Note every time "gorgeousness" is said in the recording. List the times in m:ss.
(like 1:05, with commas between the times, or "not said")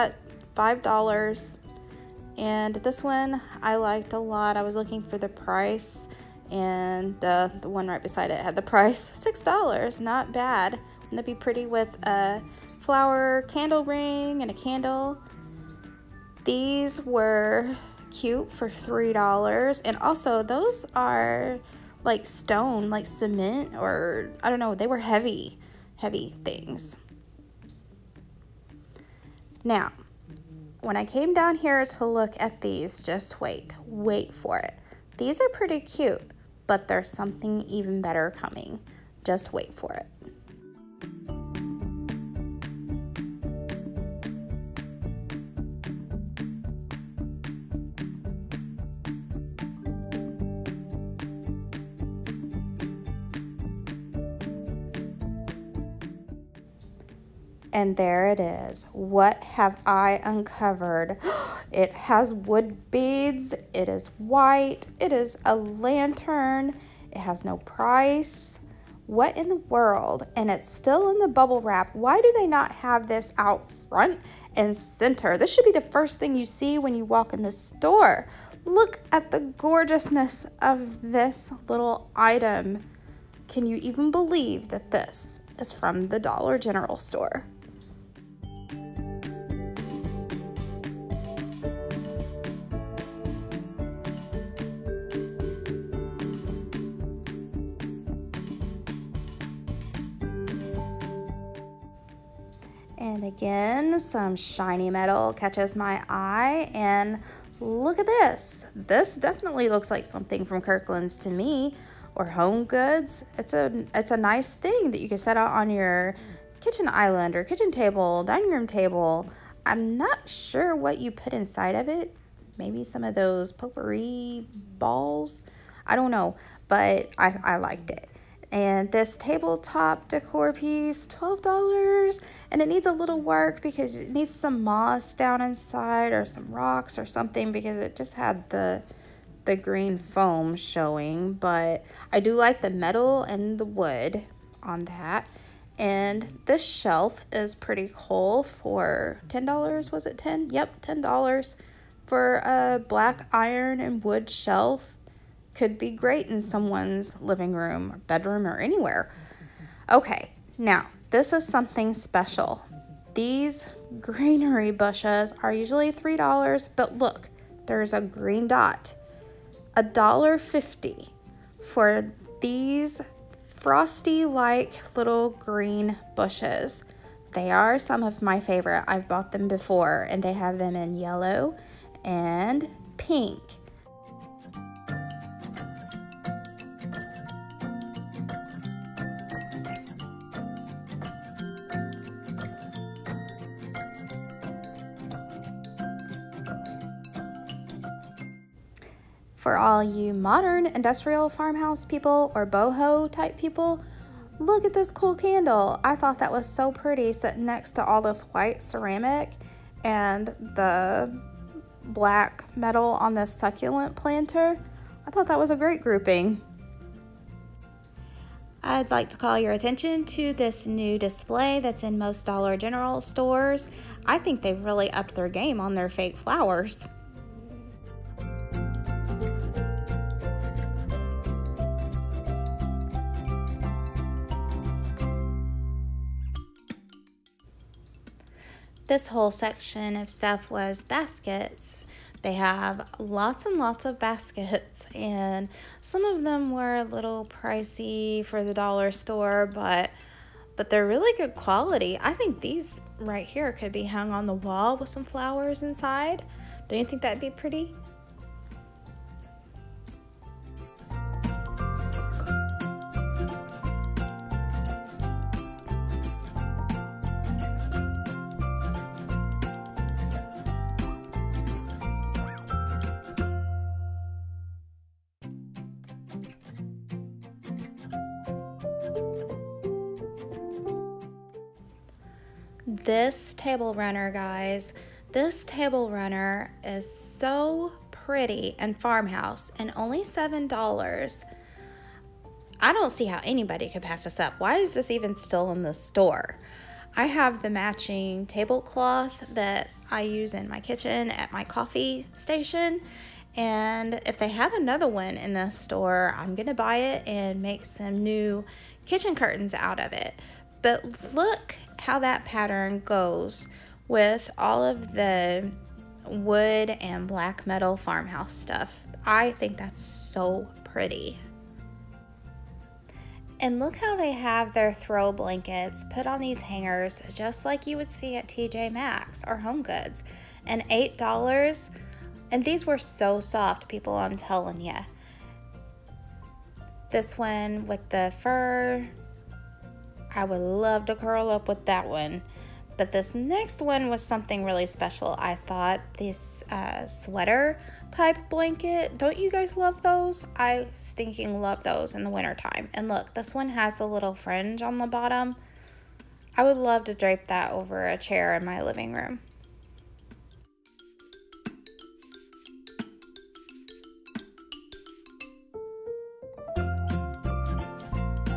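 1:19.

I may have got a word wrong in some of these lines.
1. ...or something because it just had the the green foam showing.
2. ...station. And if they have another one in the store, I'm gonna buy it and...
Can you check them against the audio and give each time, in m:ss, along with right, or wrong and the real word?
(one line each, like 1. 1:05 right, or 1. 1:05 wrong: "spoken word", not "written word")
1. 2:16 right
2. 5:02 right.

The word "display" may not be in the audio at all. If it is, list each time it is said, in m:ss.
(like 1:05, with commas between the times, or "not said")
3:40.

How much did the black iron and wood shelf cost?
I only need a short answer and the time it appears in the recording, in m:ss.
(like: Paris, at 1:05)
$10, at 2:30.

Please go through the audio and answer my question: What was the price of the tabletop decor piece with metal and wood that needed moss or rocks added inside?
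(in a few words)
$12.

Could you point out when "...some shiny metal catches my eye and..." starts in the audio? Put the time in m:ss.
1:43.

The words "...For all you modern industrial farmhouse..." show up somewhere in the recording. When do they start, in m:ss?
3:19.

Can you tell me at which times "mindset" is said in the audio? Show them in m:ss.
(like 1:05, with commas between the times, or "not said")
not said.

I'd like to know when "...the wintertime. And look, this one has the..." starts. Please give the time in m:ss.
5:52.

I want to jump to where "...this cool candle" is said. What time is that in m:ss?
3:24.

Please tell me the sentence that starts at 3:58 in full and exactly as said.
This whole section of stuff was baskets.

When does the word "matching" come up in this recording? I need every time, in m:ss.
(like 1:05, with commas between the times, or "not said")
4:57.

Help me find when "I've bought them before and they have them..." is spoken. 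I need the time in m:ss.
2:58.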